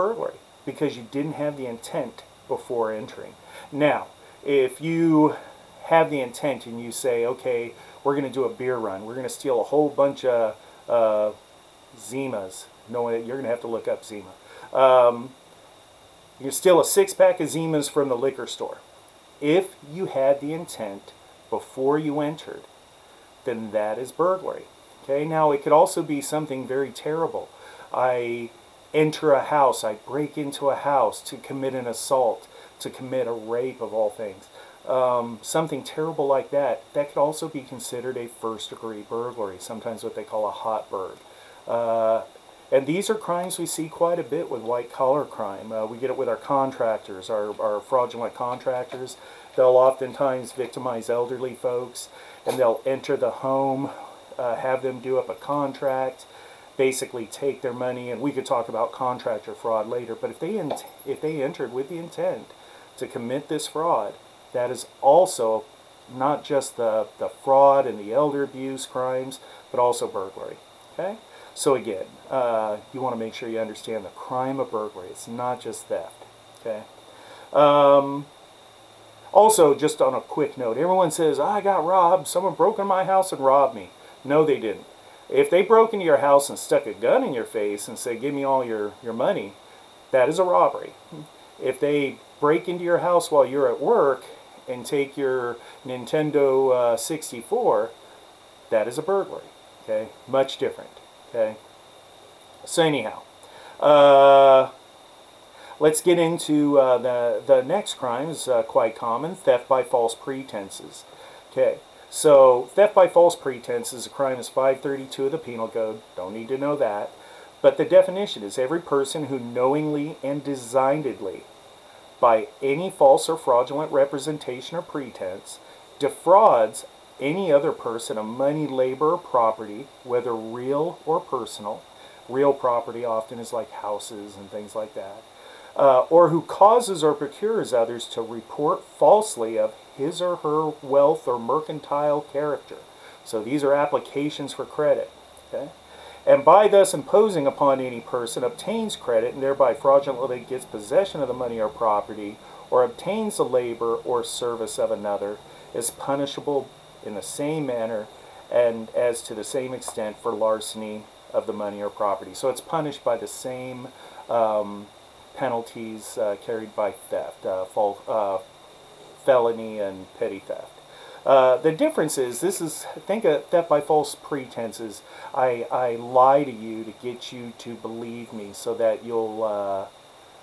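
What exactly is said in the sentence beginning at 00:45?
Uh, we get it with our contractors, our, our fraudulent contractors.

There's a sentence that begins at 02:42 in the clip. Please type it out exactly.
So it's punished by the same um, penalties uh, carried by theft, uh, uh, felony and petty theft.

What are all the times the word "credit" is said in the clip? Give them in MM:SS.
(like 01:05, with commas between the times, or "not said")
02:24, 02:28.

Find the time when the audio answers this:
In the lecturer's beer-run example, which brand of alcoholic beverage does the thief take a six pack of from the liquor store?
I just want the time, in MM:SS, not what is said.
00:16.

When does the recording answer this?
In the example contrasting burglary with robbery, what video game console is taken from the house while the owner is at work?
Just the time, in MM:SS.
01:35.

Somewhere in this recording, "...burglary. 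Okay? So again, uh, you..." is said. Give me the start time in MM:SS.
01:10.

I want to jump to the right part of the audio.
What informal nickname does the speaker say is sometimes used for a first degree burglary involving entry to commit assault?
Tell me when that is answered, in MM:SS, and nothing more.
00:40.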